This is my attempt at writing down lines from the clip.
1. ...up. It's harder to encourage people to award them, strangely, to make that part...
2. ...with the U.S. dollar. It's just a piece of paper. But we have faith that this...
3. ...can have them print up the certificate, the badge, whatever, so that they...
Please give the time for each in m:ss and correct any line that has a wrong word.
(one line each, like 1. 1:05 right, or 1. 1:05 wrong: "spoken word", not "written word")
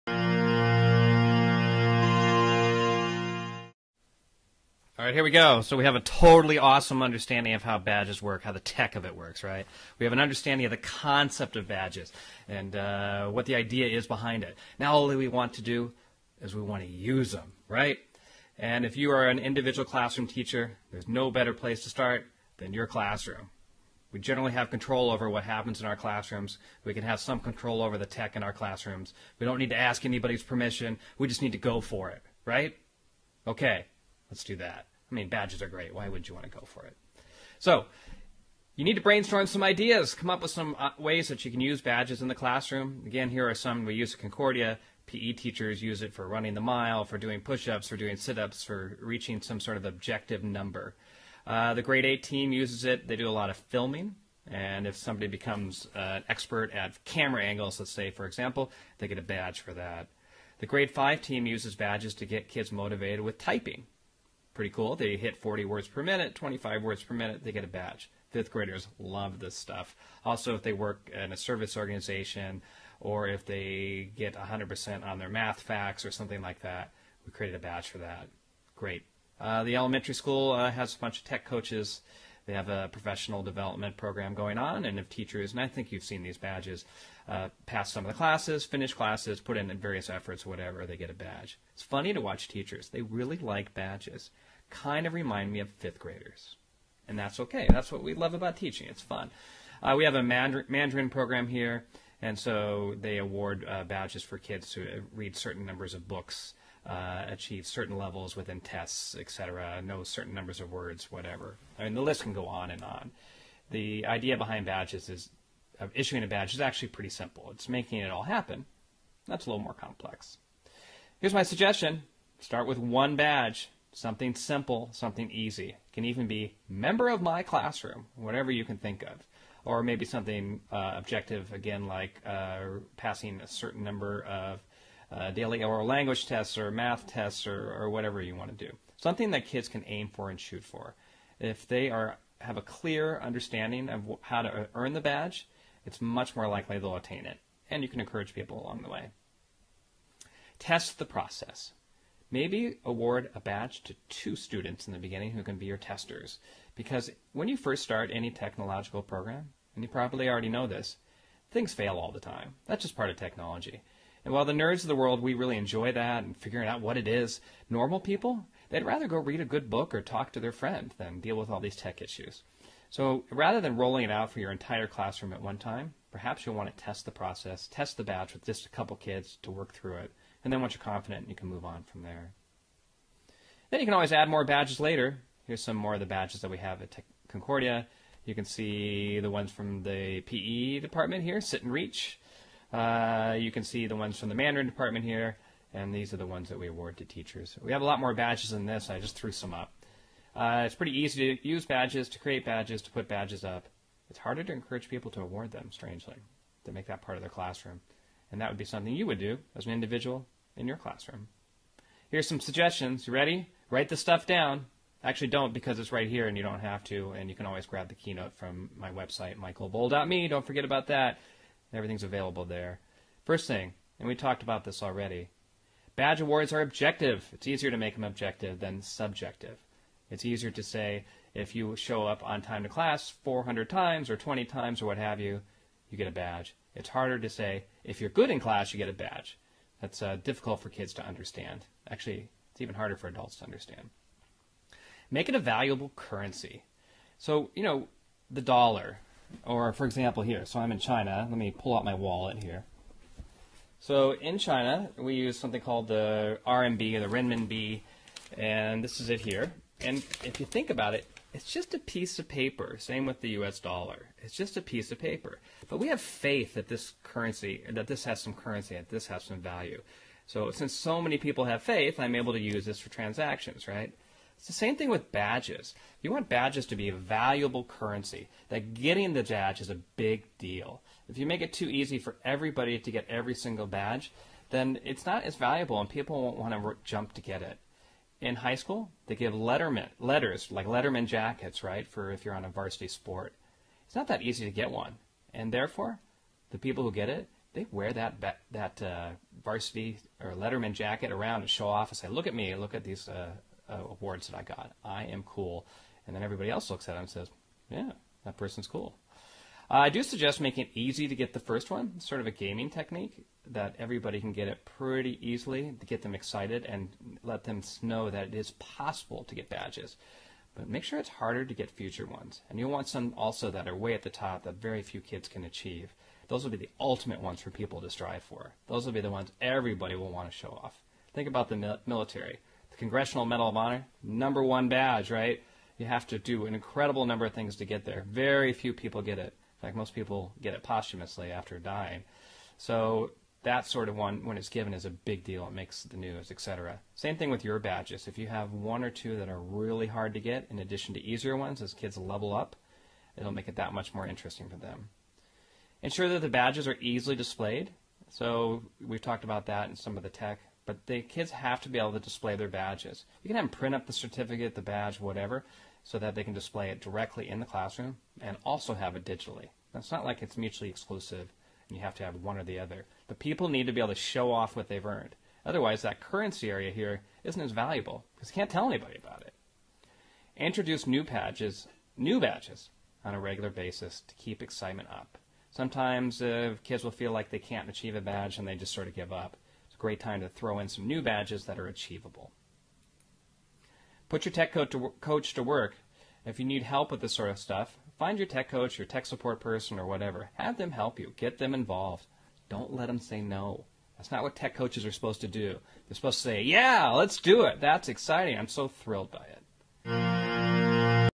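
1. 3:23 right
2. 4:23 right
3. 6:03 right.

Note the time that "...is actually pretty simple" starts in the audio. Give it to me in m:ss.
1:56.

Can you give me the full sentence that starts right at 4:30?
So since so many people have faith, I'm able to use this for transactions, right?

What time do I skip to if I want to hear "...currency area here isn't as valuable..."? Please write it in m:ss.
6:16.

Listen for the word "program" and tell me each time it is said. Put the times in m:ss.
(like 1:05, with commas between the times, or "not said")
1:23, 1:41, 2:39.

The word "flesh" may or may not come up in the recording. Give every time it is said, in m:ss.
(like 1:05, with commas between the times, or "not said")
not said.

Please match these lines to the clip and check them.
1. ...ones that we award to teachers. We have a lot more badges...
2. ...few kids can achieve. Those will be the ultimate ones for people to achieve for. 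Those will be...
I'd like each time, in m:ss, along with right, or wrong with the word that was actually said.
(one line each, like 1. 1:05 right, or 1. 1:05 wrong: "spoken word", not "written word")
1. 3:16 right
2. 5:24 wrong: "strive", not "achieve".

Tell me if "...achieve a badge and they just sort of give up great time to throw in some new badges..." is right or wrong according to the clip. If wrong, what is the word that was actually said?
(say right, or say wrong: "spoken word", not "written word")
right.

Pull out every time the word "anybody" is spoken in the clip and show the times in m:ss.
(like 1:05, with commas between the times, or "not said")
0:30, 6:18.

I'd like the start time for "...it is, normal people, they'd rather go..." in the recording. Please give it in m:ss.
2:46.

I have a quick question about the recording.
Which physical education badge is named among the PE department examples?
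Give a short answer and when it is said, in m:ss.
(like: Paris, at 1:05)
Sit and Reach, at 3:11.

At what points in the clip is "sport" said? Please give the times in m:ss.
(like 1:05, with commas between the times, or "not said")
4:52.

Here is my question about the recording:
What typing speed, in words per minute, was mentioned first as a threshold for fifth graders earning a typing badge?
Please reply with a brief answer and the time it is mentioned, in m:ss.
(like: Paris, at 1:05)
40, at 1:05.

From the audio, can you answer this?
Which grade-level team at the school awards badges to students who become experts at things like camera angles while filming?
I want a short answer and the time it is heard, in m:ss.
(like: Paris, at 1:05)
Grade 8, at 0:51.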